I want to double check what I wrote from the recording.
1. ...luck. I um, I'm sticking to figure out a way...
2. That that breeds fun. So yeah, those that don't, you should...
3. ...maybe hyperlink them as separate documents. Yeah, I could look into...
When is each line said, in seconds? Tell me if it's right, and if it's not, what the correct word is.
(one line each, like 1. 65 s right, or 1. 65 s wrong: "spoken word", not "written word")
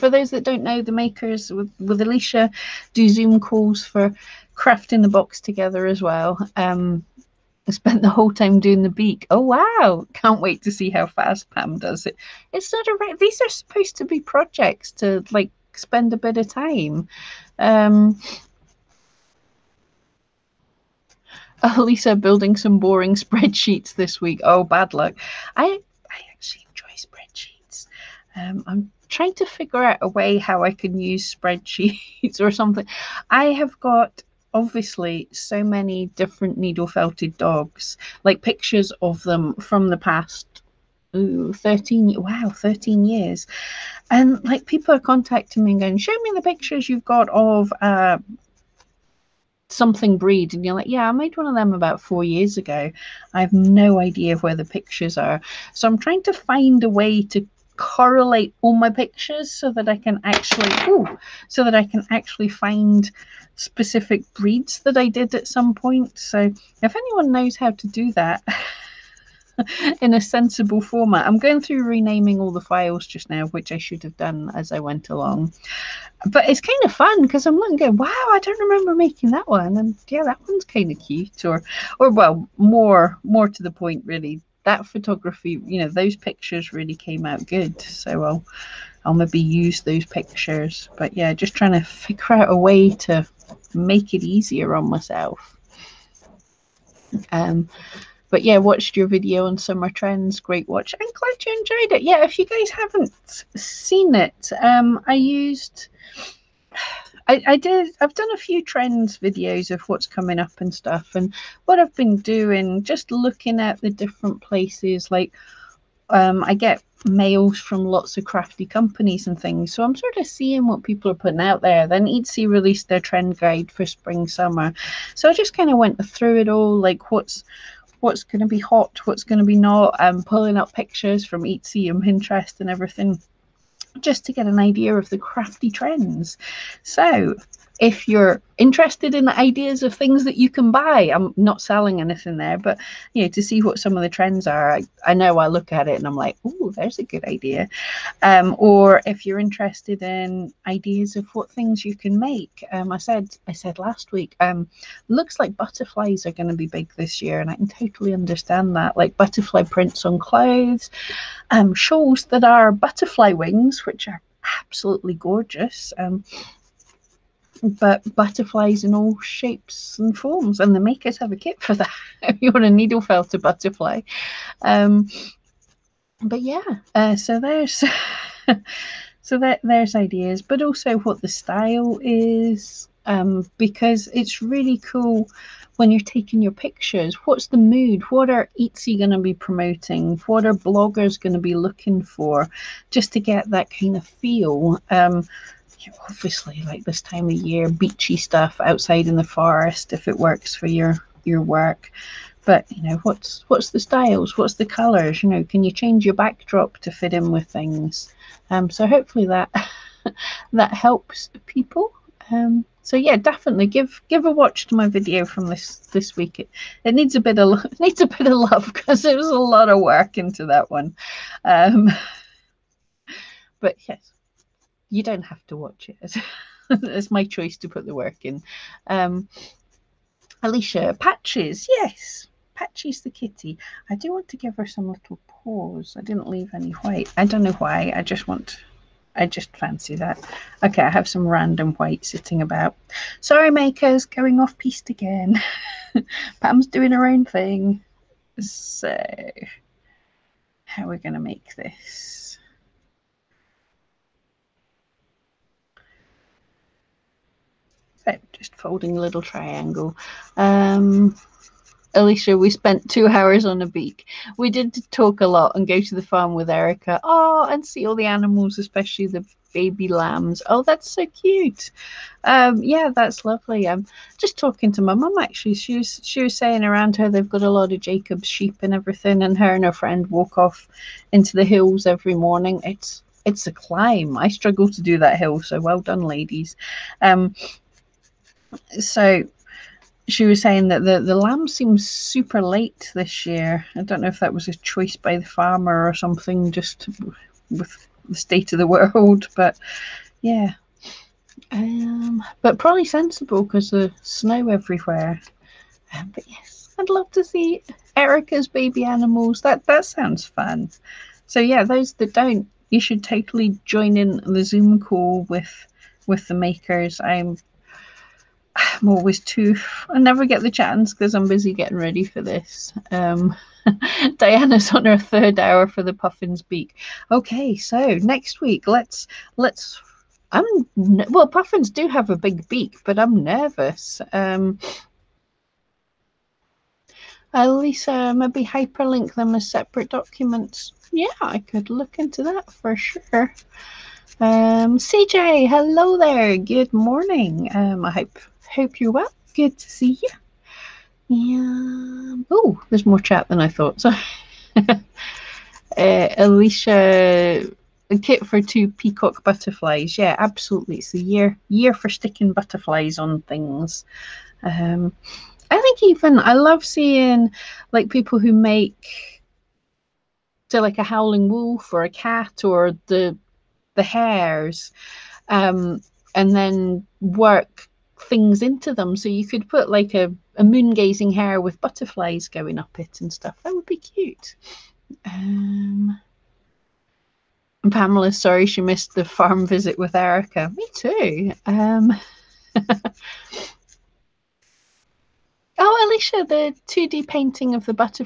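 1. 24 s wrong: "trying", not "sticking"
2. 309 s wrong: "sounds", not "breeds"
3. 338 s right.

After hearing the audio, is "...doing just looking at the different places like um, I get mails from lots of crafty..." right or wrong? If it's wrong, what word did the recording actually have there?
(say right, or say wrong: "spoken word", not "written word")
right.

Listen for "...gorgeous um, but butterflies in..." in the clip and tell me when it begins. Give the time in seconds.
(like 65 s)
165 s.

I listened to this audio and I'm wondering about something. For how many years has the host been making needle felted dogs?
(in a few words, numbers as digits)
13.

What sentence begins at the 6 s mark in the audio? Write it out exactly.
Um, I spent the whole time doing the beak.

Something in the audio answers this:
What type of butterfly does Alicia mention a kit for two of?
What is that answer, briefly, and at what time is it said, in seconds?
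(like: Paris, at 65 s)
Peacock butterflies, at 358 s.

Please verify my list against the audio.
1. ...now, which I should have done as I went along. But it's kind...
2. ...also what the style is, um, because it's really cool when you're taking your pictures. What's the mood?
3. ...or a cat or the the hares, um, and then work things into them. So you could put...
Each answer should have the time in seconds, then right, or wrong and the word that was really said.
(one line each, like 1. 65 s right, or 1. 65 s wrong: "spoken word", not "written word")
1. 73 s right
2. 180 s right
3. 371 s right.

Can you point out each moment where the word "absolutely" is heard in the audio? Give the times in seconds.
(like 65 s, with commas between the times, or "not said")
164 s, 360 s.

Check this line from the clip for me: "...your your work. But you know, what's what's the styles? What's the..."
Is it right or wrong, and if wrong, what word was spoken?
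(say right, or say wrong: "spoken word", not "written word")
right.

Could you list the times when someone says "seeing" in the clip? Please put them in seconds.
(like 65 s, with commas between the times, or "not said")
120 s, 366 s.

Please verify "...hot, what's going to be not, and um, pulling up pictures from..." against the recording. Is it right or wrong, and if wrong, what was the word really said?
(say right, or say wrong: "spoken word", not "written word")
right.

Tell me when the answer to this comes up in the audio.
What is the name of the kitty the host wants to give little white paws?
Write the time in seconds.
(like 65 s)
232 s.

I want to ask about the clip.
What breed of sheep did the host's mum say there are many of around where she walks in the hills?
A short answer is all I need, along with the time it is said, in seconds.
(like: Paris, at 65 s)
Jacob's sheep, at 277 s.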